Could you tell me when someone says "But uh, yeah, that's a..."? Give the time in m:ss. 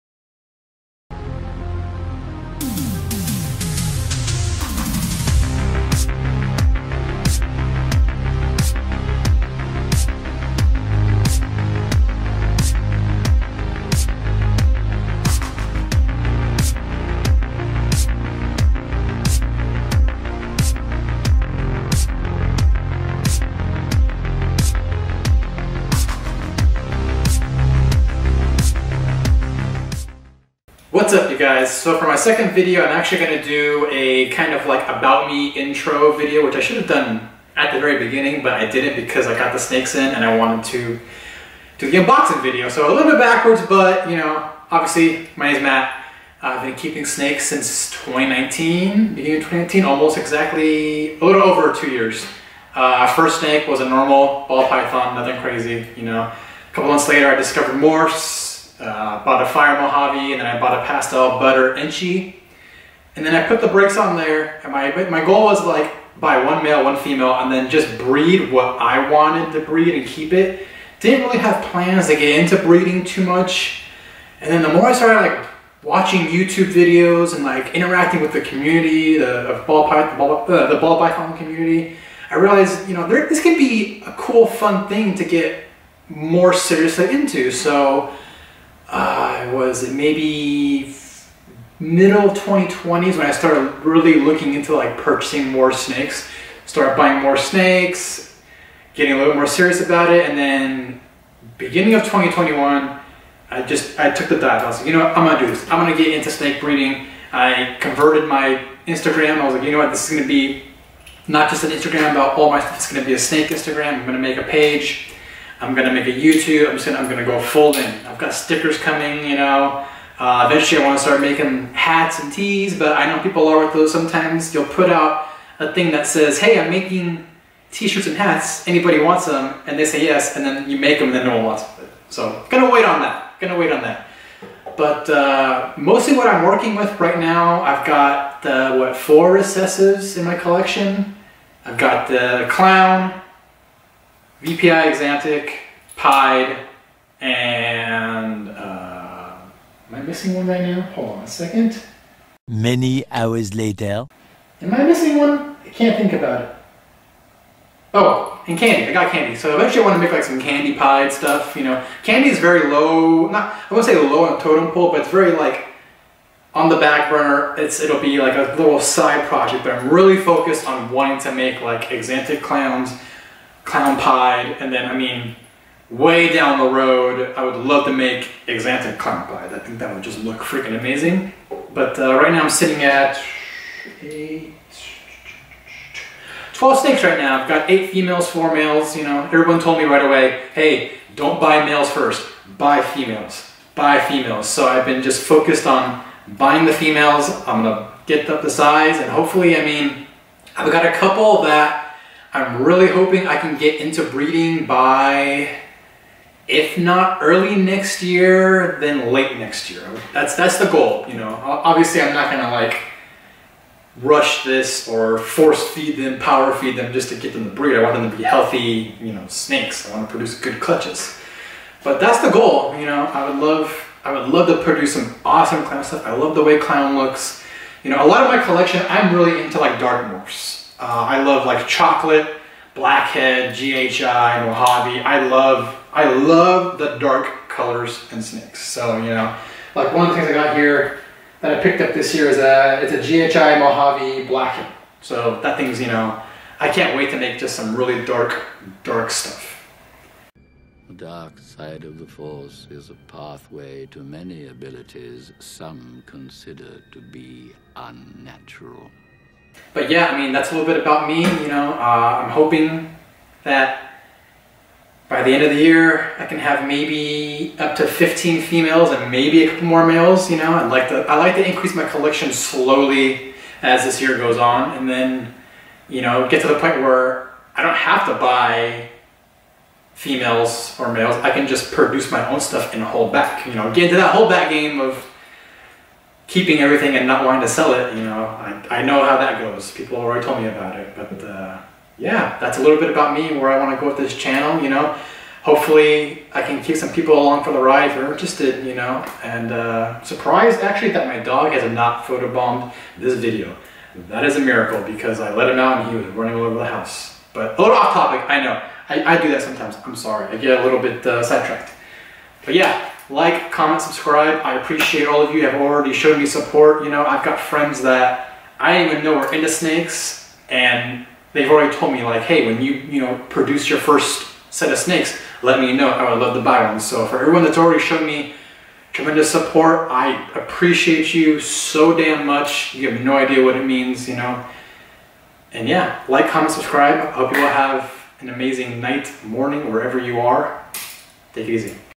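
4:50.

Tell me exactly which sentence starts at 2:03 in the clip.
Sometimes you'll put out a thing that says, "Hey, I'm making t-shirts and hats.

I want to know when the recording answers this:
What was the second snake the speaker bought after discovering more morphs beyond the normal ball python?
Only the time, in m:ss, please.
0:59.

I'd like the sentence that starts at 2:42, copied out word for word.
Candy is very low, not, I won't say low on totem pole, but it's very like on the back burner.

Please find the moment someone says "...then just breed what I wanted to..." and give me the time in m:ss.
1:07.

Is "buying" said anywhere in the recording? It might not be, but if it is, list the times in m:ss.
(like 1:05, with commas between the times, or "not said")
1:36, 3:16.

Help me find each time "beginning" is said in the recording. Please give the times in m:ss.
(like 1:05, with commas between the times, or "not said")
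0:37, 0:49, 1:41.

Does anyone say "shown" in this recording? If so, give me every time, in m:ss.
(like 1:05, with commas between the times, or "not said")
5:15, 5:27.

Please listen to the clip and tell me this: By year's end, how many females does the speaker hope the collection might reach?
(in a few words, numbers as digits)
15.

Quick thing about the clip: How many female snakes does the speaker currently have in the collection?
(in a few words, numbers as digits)
8.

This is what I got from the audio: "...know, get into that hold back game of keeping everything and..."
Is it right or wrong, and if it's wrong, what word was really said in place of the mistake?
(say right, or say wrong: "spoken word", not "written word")
right.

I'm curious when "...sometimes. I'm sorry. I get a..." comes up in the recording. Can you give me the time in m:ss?
5:09.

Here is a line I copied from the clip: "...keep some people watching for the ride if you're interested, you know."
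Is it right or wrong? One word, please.
wrong.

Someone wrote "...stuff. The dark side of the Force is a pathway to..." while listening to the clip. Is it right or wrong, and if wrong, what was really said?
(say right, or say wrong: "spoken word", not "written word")
right.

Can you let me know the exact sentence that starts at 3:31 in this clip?
Obviously, I'm not gonna like rush this or force feed them, power feed them just to get them to breed.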